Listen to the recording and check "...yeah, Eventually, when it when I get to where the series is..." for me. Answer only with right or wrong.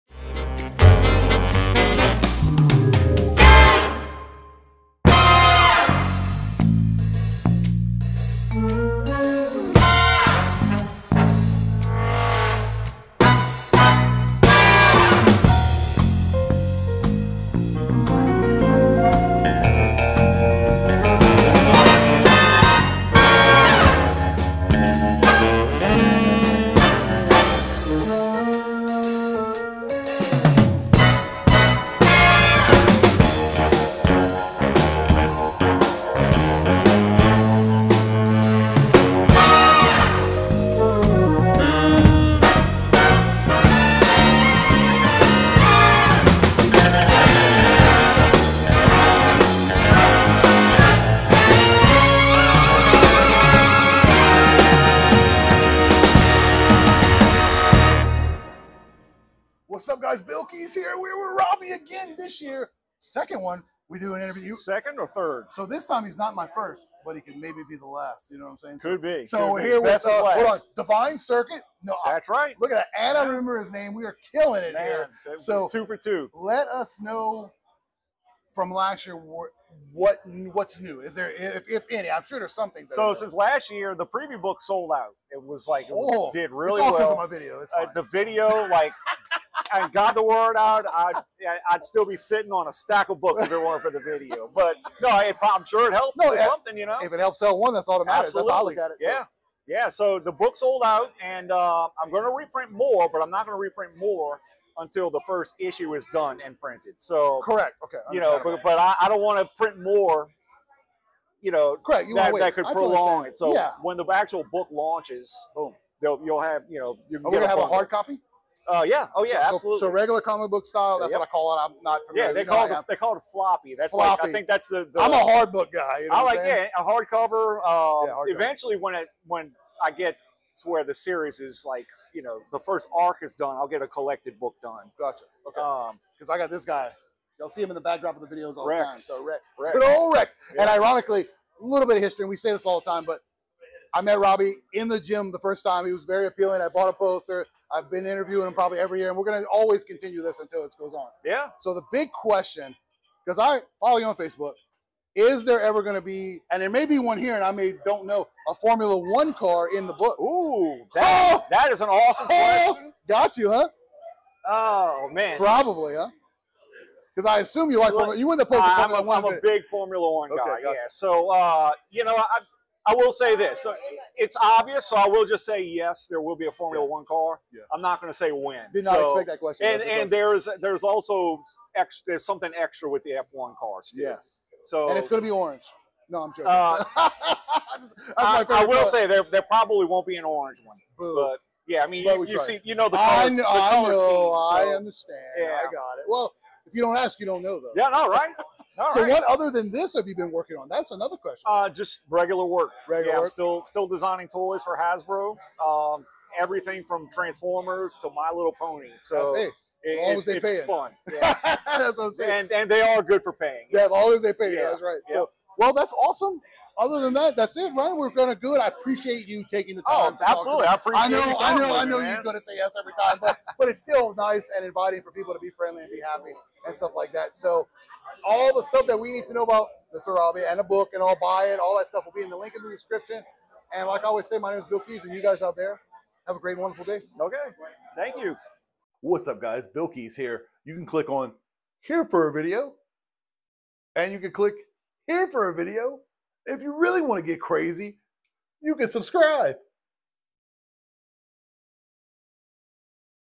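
right.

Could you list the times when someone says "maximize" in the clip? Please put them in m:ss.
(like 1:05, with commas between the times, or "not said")
not said.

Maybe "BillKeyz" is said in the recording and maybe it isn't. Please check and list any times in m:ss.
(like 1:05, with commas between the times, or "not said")
1:00, 3:54, 3:59.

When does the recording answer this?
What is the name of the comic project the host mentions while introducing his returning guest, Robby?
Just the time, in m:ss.
1:10.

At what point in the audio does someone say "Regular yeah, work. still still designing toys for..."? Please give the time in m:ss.
3:22.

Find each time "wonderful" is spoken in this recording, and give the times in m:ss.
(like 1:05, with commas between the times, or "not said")
3:56.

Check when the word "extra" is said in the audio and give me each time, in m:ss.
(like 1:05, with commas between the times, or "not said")
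3:02.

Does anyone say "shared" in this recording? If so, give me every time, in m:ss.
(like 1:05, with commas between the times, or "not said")
not said.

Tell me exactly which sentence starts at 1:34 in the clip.
But no, it, I'm sure it helped no, it, something, you know.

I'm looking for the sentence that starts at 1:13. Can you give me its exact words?
We are killing it Man, here.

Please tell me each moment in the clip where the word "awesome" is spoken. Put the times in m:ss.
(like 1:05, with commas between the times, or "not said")
2:41, 3:35.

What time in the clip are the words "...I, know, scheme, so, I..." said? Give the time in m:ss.
3:13.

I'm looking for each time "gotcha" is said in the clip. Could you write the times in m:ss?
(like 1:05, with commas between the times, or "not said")
2:14, 2:50.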